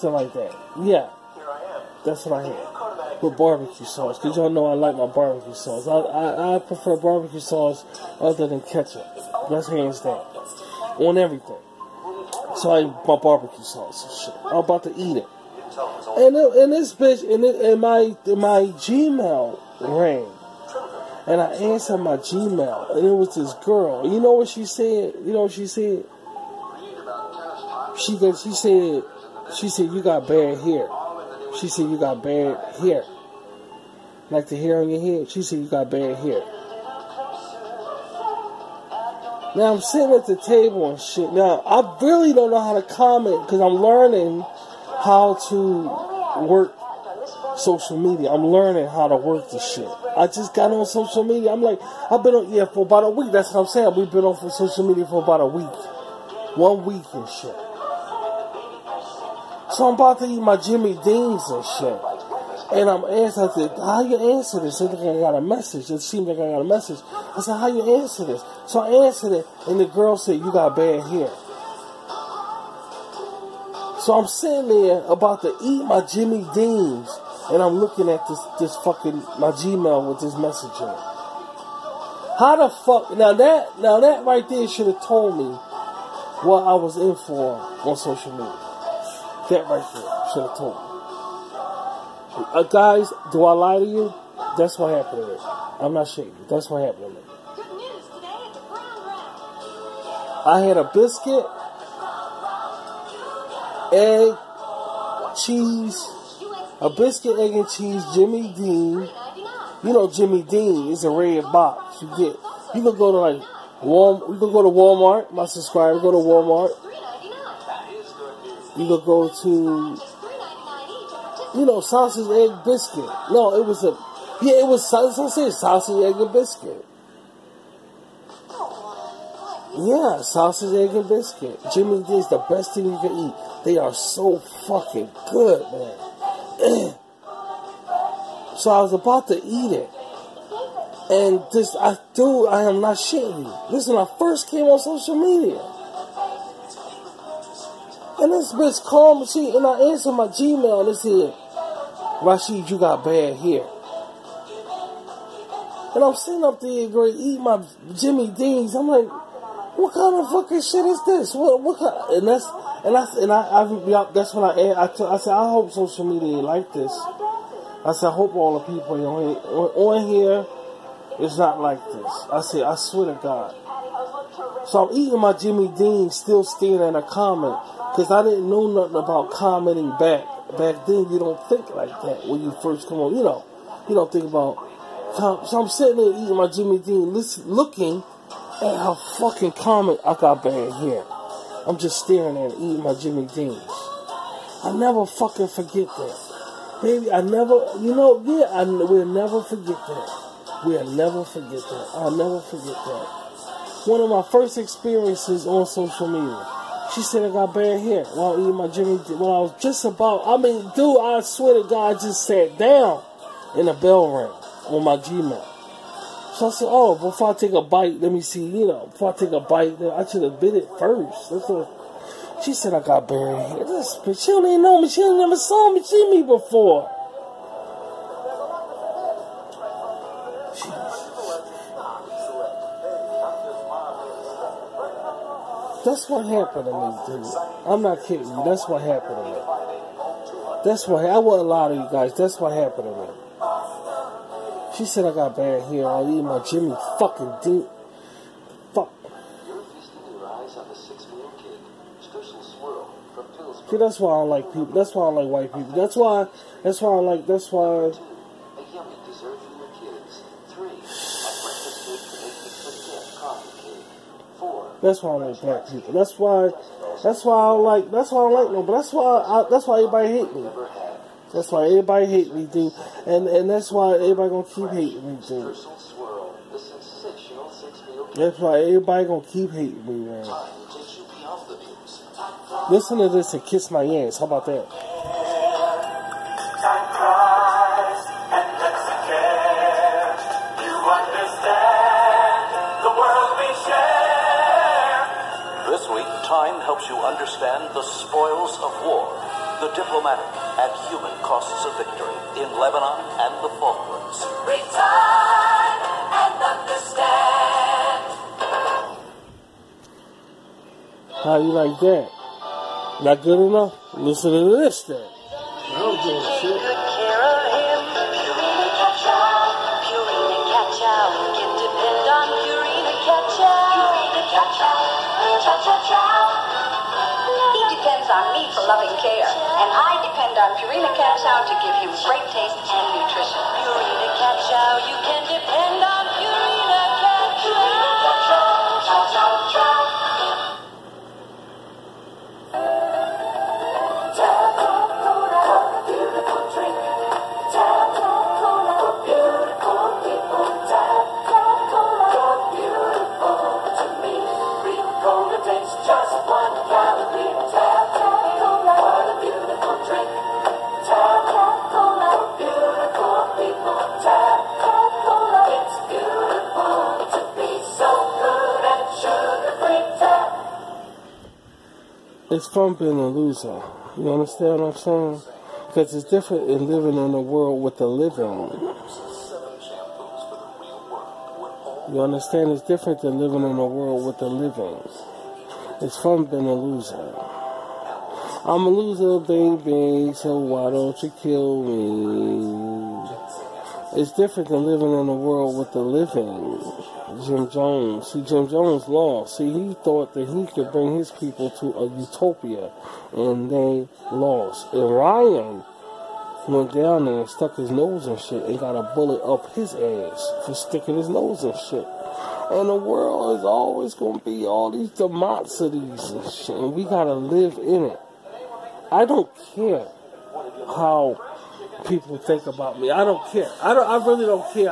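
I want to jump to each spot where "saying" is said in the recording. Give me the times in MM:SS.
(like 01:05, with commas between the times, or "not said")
00:53, 06:14.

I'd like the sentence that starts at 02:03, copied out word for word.
No, it was a yeah, it was, sausage, sausage, egg, and biscuit.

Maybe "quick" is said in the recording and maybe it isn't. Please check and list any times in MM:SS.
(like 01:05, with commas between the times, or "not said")
not said.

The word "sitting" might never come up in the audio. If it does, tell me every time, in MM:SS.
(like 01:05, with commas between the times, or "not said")
00:39, 01:14, 02:36, 03:05.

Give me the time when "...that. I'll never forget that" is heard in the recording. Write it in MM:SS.
03:21.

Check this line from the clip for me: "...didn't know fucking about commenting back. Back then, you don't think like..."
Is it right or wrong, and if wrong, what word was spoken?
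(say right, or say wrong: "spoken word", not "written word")
wrong: "nothing", not "fucking".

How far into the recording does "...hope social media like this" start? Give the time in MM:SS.
02:45.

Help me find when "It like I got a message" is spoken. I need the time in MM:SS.
01:04.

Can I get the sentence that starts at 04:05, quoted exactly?
I eat my Jimmy fucking deep.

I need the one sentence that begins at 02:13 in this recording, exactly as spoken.
They are so fucking good, man.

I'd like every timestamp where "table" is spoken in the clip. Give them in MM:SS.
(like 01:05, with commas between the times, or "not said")
00:40.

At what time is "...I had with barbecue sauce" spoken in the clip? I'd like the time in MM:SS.
00:02.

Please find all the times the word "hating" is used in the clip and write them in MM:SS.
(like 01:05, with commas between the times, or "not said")
04:34, 04:39.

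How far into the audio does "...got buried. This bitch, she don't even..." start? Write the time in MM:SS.
03:42.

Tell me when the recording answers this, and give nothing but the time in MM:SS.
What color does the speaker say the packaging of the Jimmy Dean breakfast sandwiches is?
01:51.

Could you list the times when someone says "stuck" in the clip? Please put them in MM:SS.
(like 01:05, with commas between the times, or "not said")
06:47.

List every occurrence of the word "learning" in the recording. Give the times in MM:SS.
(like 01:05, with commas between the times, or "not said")
00:43, 00:48.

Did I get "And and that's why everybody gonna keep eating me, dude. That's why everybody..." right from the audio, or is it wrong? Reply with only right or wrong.
wrong.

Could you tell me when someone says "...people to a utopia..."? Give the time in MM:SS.
06:41.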